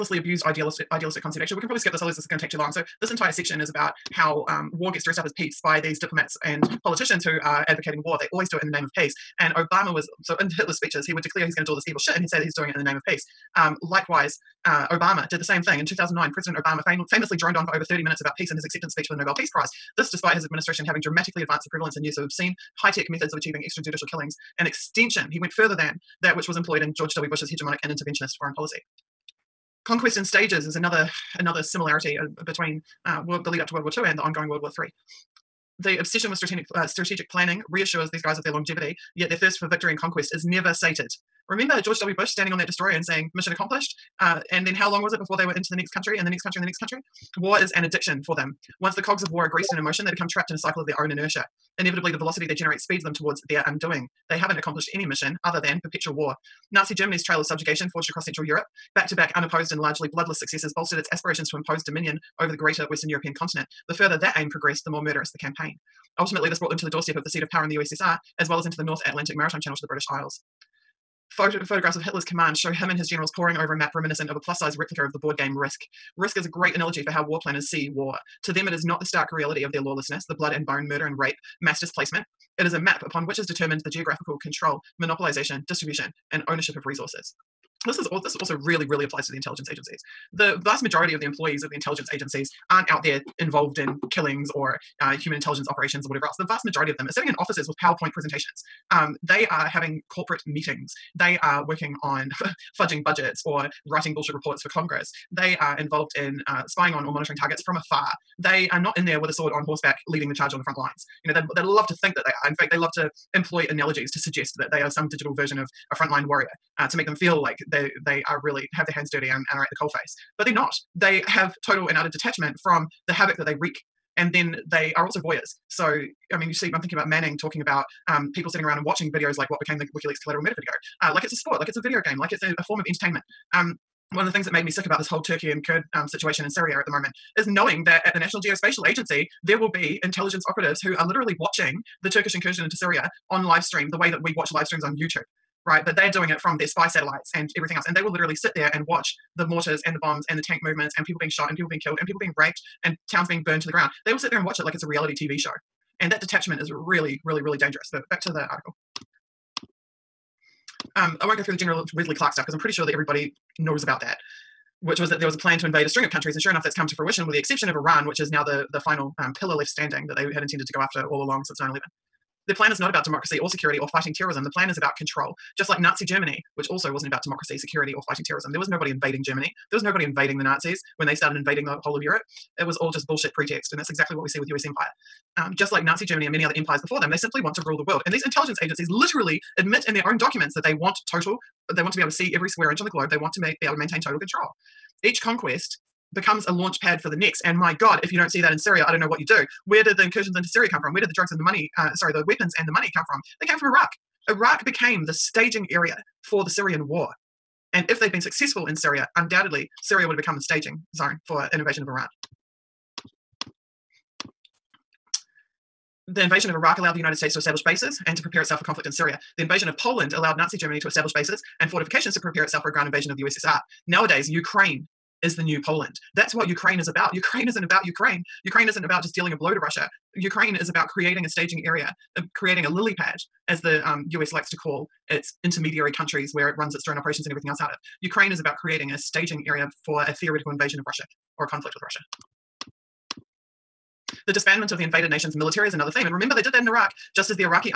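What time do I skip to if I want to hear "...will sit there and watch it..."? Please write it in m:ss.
2:34.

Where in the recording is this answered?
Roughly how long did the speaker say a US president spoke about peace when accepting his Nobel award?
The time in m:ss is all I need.
0:17.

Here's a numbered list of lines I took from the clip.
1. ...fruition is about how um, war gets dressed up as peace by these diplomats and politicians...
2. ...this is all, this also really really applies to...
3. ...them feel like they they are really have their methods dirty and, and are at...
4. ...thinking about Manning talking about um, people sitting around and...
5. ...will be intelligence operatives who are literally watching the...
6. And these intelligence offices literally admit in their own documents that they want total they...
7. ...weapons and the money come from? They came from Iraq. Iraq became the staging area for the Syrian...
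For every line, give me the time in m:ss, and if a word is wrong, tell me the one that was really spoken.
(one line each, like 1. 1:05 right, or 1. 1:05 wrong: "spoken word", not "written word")
1. 0:03 wrong: "section", not "fruition"
2. 1:27 right
3. 1:57 wrong: "hands", not "methods"
4. 2:06 right
5. 2:19 right
6. 3:08 wrong: "agencies", not "offices"
7. 3:22 right.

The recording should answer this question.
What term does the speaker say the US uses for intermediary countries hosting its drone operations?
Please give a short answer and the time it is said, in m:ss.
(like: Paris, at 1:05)
lily pad, at 3:52.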